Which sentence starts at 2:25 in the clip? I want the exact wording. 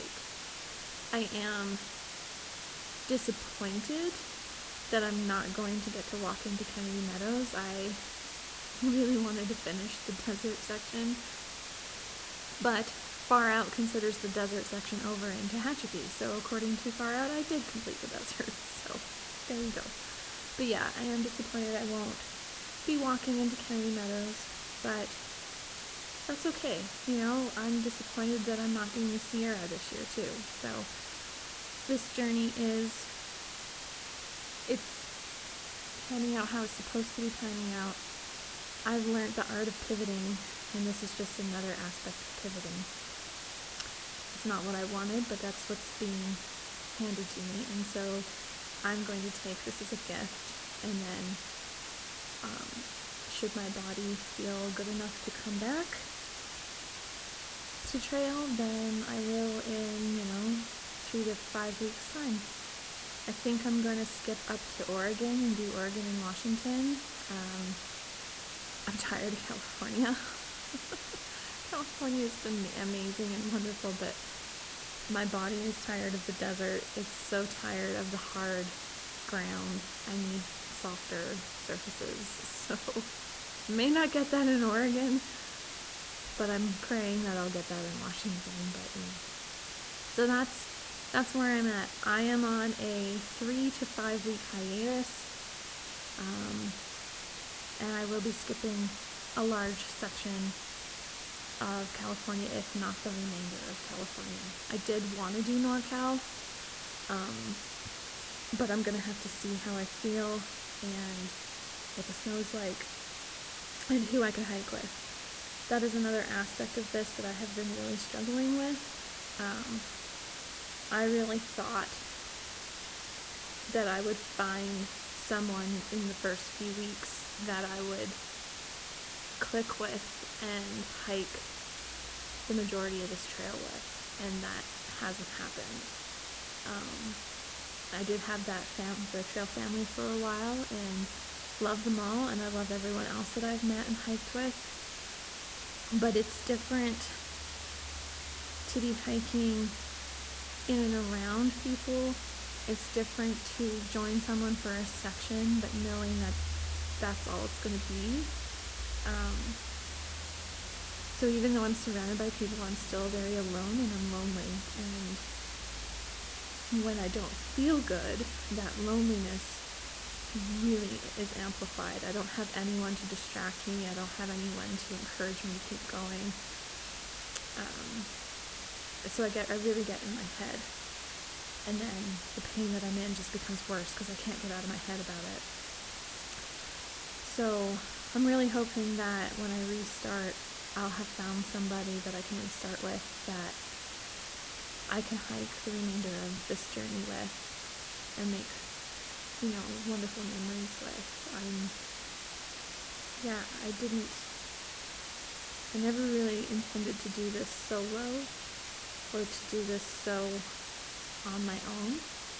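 But it's different to be hiking in and around people.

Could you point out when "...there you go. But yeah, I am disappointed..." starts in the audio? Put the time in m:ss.
0:19.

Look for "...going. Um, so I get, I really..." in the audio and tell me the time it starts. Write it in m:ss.
2:55.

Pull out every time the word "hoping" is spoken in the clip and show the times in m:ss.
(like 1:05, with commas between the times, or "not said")
3:08.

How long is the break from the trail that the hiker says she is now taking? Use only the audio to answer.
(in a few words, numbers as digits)
3 to 5 weeks.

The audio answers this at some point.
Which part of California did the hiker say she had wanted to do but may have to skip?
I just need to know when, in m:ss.
1:45.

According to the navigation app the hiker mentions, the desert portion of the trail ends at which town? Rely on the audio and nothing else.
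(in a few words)
Tehachapi.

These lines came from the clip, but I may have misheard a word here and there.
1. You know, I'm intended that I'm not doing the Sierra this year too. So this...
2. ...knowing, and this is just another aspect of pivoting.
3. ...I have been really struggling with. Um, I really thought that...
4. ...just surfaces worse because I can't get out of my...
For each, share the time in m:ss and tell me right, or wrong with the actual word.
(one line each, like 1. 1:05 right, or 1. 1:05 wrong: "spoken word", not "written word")
1. 0:27 wrong: "disappointed", not "intended"
2. 0:39 wrong: "pivoting", not "knowing"
3. 1:57 right
4. 3:03 wrong: "becomes", not "surfaces".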